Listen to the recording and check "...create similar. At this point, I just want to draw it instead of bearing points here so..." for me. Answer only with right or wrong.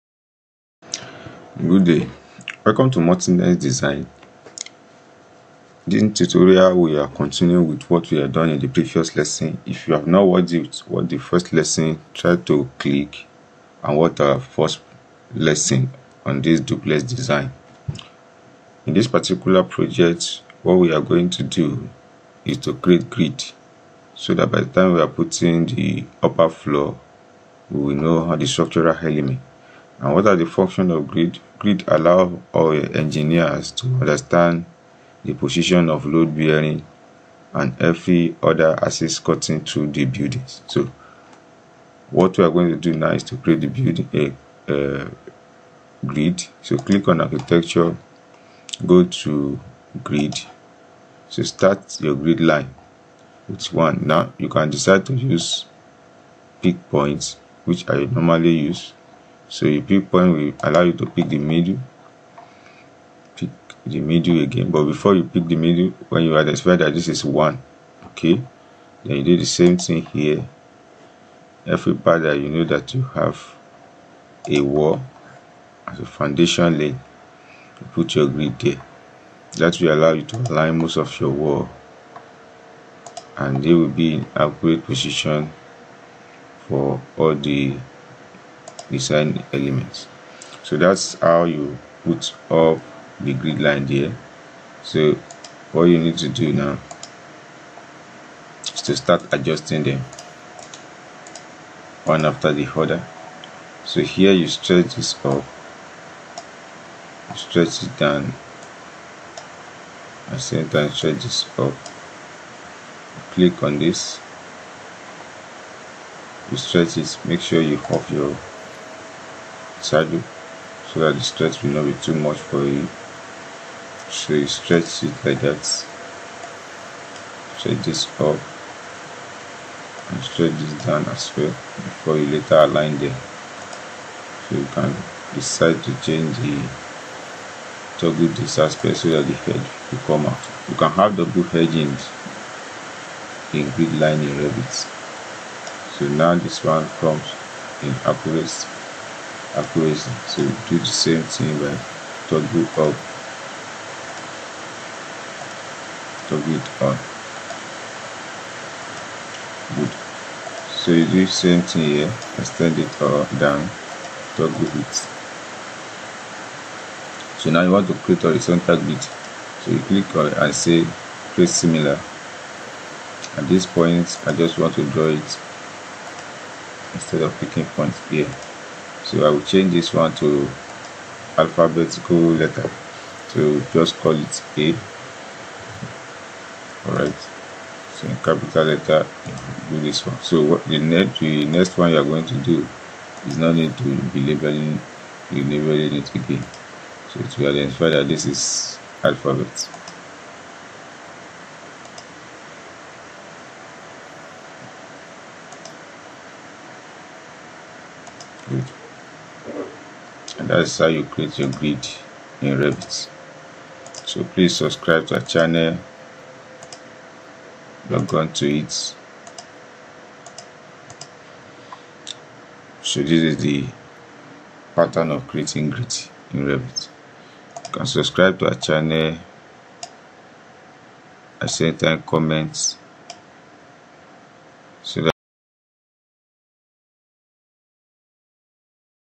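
wrong.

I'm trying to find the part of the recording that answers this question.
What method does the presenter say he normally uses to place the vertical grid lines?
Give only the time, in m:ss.
0:56.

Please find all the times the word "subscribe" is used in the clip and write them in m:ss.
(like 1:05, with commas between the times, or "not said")
3:34, 3:47.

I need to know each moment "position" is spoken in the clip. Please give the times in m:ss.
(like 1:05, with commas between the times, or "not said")
0:35, 1:24.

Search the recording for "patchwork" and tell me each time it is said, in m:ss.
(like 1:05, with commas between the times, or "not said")
not said.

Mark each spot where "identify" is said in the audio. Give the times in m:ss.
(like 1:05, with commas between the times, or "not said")
1:06, 3:17.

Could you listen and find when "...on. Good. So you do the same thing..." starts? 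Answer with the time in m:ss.
2:36.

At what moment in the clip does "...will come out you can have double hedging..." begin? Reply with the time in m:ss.
2:19.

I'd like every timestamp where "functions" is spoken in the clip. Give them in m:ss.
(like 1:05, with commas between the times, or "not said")
0:30.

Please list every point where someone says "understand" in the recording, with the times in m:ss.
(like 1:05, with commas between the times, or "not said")
0:34.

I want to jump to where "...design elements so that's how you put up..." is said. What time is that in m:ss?
1:28.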